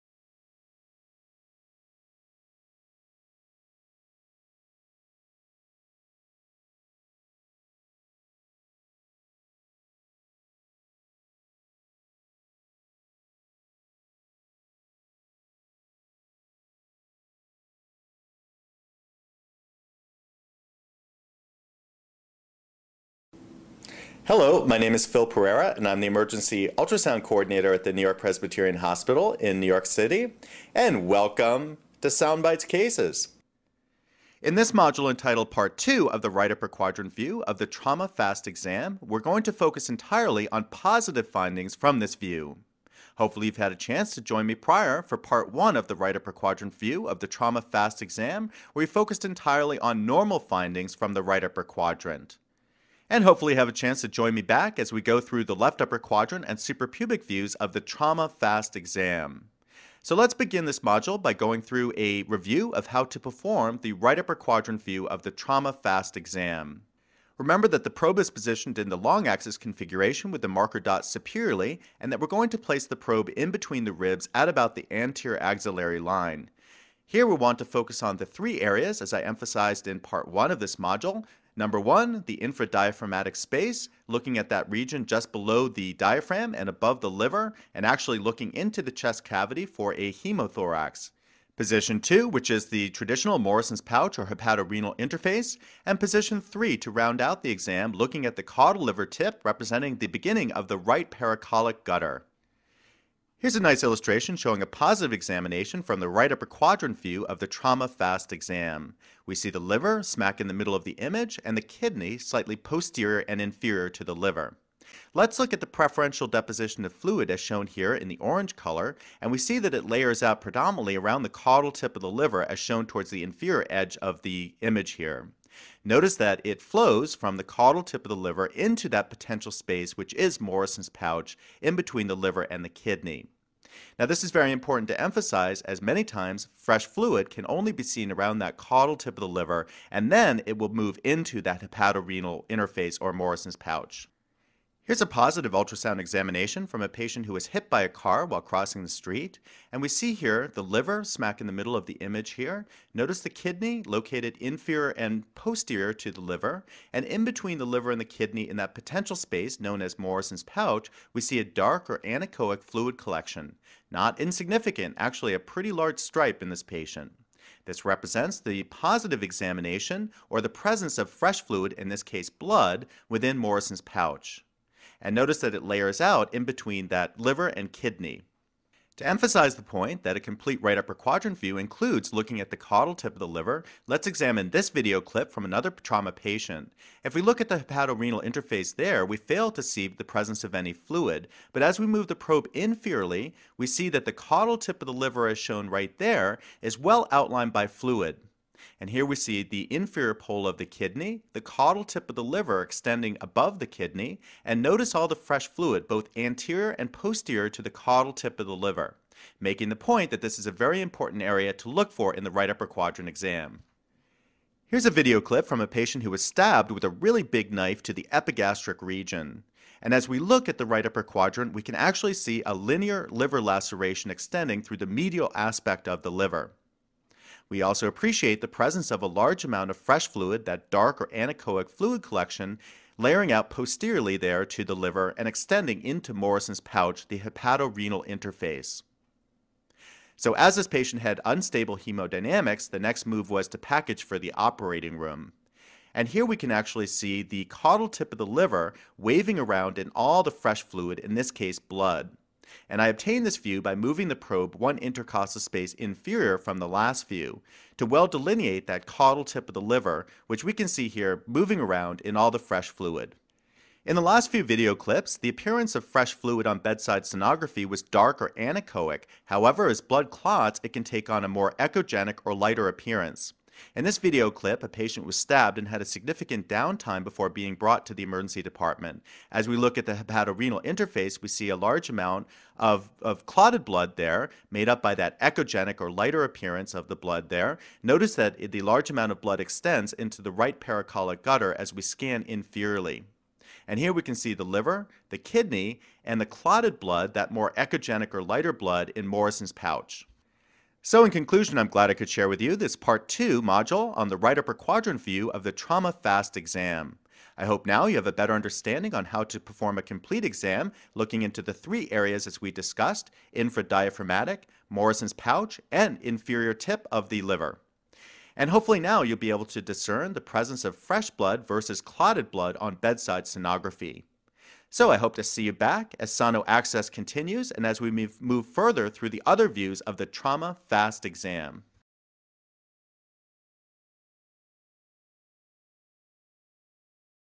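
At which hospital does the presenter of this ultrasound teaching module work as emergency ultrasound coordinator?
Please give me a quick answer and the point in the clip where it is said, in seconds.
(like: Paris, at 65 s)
New York Presbyterian Hospital, at 27 s.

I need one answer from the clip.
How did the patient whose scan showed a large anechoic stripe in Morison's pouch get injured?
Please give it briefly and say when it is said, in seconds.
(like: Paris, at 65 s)
hit by a car, at 147 s.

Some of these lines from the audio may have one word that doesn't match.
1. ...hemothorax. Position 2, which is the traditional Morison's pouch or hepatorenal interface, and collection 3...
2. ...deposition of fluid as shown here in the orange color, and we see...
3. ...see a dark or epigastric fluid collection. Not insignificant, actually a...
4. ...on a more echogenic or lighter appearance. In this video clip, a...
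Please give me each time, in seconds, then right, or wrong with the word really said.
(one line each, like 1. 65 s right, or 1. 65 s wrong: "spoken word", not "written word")
1. 90 s wrong: "position", not "collection"
2. 116 s right
3. 161 s wrong: "anechoic", not "epigastric"
4. 271 s right.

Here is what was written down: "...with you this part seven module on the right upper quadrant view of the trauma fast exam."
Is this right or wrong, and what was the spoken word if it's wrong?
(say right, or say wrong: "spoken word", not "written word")
wrong: "two", not "seven".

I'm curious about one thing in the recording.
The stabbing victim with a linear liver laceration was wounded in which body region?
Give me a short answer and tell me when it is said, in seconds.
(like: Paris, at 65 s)
epigastric region, at 218 s.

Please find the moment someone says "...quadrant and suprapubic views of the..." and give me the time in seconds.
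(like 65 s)
55 s.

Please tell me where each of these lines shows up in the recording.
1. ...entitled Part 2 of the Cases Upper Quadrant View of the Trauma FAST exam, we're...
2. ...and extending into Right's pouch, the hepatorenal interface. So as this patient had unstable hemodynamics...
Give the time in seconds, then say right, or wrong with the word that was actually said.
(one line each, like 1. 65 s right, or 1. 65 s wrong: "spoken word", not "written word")
1. 35 s wrong: "Right", not "Cases"
2. 235 s wrong: "Morison", not "Right".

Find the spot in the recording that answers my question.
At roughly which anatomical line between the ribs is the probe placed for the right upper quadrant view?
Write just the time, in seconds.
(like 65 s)
74 s.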